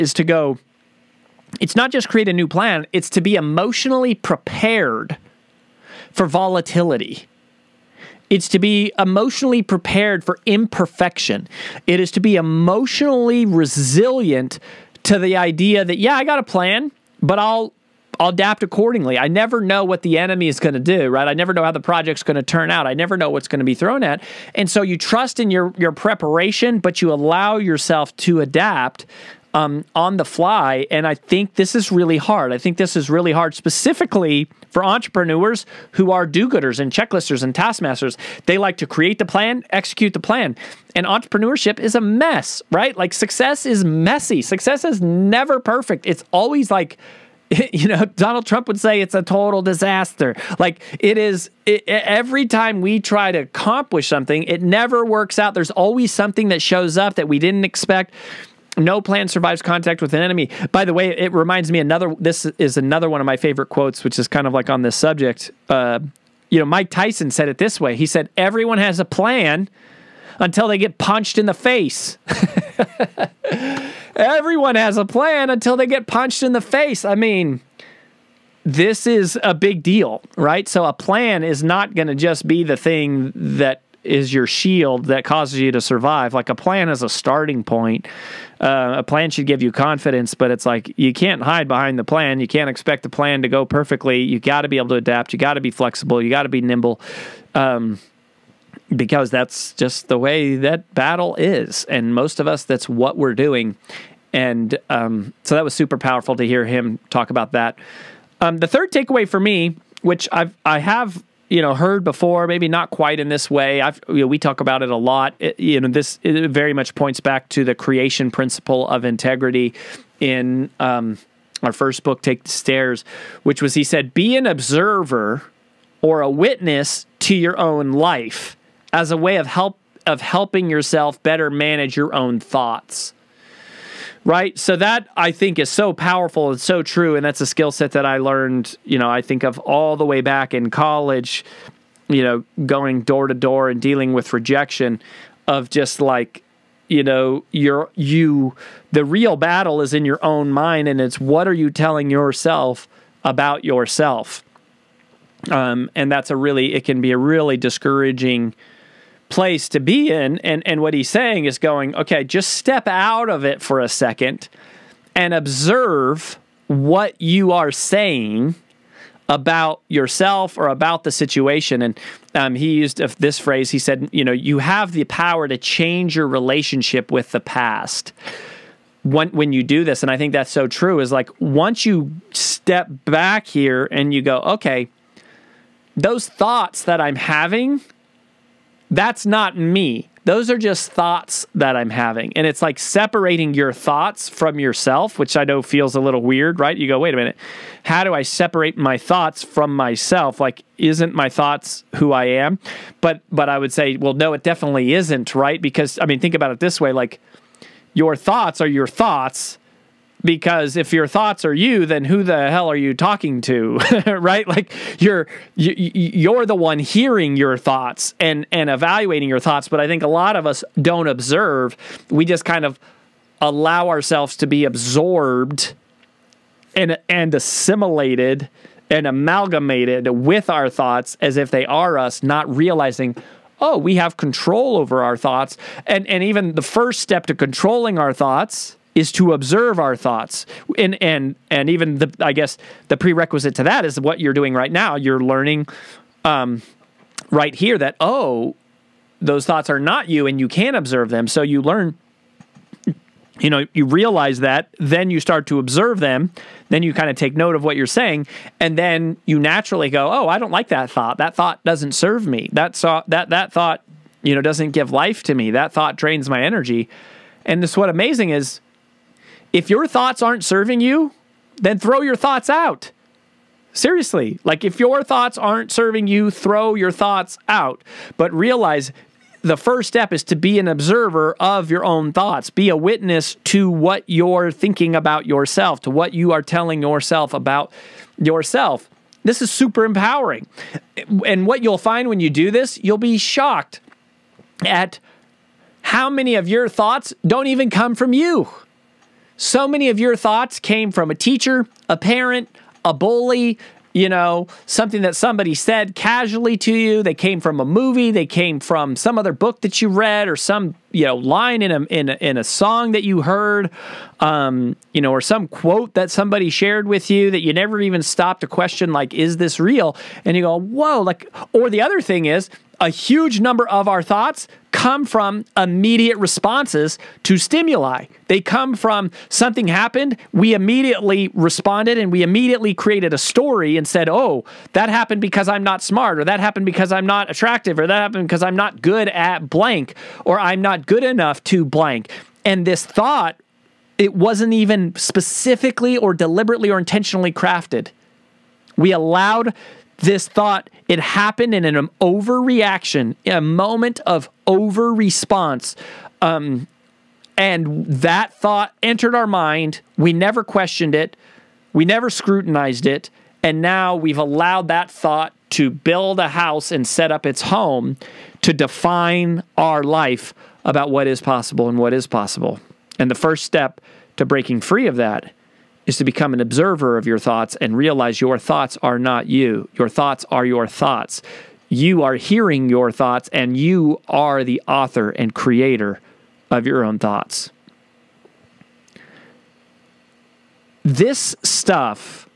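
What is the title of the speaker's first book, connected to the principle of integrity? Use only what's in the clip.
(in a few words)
Take the Stairs.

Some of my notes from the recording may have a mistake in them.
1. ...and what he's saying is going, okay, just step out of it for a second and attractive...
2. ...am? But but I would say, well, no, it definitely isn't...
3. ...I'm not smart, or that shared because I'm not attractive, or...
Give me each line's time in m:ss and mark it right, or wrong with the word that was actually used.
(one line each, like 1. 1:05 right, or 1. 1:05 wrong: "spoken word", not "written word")
1. 2:40 wrong: "observe", not "attractive"
2. 3:22 right
3. 5:35 wrong: "happened", not "shared".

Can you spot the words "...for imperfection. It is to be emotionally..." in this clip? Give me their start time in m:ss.
0:10.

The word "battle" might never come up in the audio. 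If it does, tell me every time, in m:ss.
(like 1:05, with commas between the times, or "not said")
1:40, 2:29.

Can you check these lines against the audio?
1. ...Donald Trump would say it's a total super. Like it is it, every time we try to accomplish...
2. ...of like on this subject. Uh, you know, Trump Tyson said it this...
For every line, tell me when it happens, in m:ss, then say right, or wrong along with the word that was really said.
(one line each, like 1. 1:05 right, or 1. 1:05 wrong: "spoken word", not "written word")
1. 0:48 wrong: "disaster", not "super"
2. 1:04 wrong: "Mike", not "Trump".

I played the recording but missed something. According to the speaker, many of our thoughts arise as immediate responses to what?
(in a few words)
Stimuli.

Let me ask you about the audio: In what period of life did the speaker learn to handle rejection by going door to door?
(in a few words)
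College.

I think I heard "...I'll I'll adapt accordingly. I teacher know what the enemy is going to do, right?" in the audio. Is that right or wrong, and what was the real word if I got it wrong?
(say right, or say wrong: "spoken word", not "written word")
wrong: "never", not "teacher".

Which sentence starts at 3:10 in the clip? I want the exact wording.
Those are just thoughts that I'm having.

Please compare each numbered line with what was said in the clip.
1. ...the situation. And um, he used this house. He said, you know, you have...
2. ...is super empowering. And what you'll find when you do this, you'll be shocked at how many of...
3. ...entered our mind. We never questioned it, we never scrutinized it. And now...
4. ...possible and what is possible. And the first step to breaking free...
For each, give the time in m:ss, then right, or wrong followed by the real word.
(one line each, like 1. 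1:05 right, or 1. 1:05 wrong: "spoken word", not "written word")
1. 2:51 wrong: "phrase", not "house"
2. 4:49 right
3. 5:58 right
4. 6:11 right.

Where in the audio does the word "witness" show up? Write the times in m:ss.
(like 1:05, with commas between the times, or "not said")
2:06, 4:42.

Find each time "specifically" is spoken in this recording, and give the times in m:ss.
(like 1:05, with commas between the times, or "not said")
0:33, 5:44.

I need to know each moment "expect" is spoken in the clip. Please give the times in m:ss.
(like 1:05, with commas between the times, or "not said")
0:57, 1:32.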